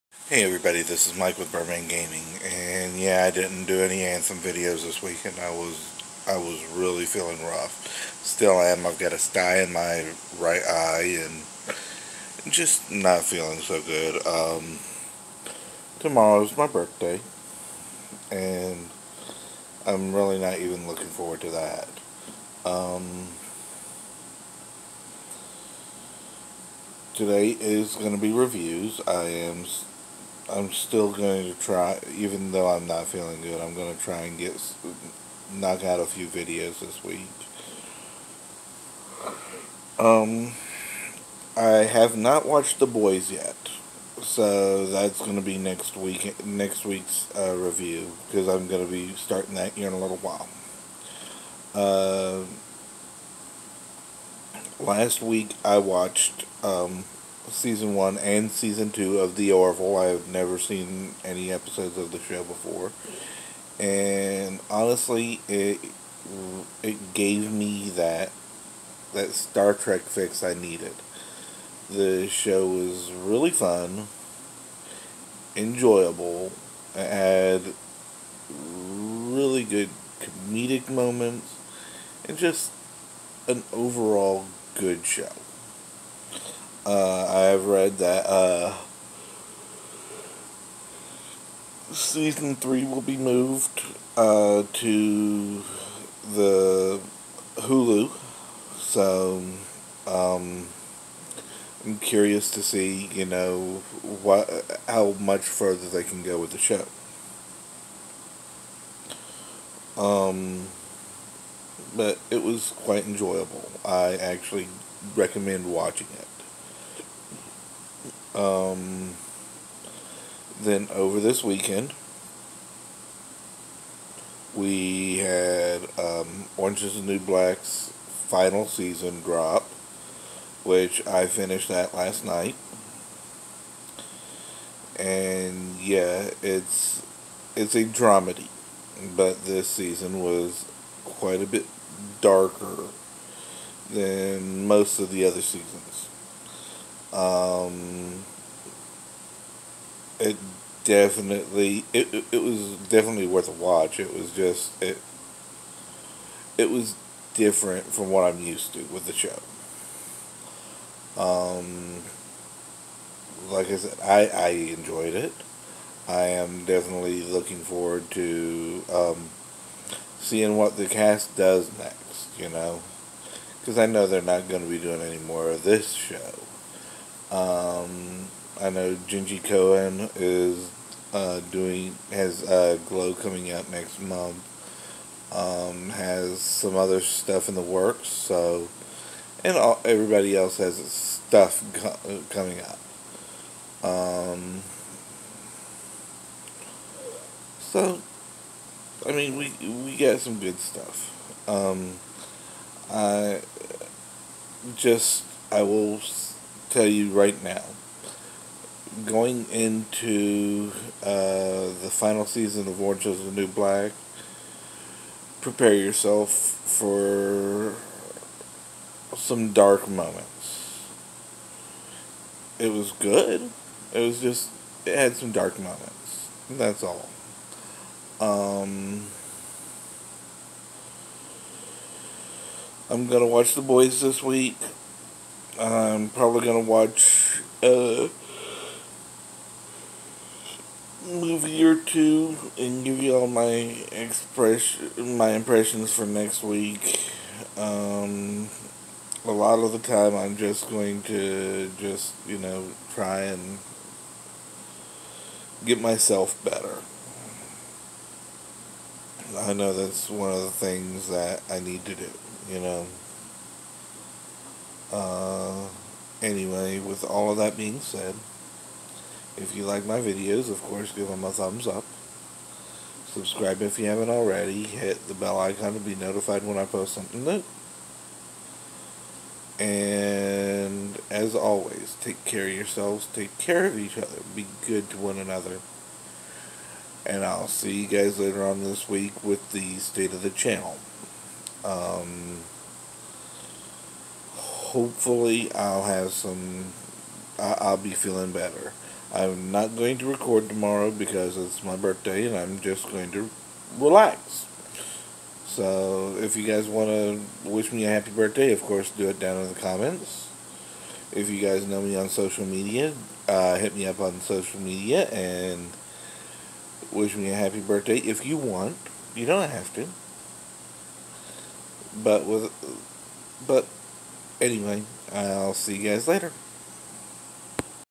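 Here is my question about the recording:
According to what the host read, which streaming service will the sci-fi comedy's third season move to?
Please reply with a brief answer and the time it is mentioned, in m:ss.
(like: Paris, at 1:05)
Hulu, at 1:37.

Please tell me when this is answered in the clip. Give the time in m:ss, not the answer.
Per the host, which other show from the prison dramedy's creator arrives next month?
3:02.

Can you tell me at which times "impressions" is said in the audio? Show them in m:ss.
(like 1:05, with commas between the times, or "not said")
4:05.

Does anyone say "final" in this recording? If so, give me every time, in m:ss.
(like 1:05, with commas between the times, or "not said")
2:08, 3:31.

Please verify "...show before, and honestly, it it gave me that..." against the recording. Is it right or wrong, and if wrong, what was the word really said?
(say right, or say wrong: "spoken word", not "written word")
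right.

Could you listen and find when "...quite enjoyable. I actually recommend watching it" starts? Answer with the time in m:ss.
1:52.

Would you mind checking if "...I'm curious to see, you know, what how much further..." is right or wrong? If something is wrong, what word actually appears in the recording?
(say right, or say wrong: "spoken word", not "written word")
right.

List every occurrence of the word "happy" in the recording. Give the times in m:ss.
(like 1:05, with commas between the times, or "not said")
5:07, 5:17.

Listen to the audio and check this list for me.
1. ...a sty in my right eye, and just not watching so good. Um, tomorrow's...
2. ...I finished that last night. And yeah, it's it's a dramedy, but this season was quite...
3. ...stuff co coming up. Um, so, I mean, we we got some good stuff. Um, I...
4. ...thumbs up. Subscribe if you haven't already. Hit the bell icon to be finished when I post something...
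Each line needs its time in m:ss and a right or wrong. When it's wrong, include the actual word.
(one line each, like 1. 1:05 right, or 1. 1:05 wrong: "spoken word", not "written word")
1. 0:09 wrong: "feeling", not "watching"
2. 2:11 right
3. 3:10 right
4. 4:31 wrong: "notified", not "finished".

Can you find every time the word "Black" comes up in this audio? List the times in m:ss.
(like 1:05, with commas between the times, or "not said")
2:07, 3:33.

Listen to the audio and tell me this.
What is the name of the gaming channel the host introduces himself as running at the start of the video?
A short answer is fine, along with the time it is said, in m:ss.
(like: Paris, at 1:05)
Birdman Gaming, at 0:01.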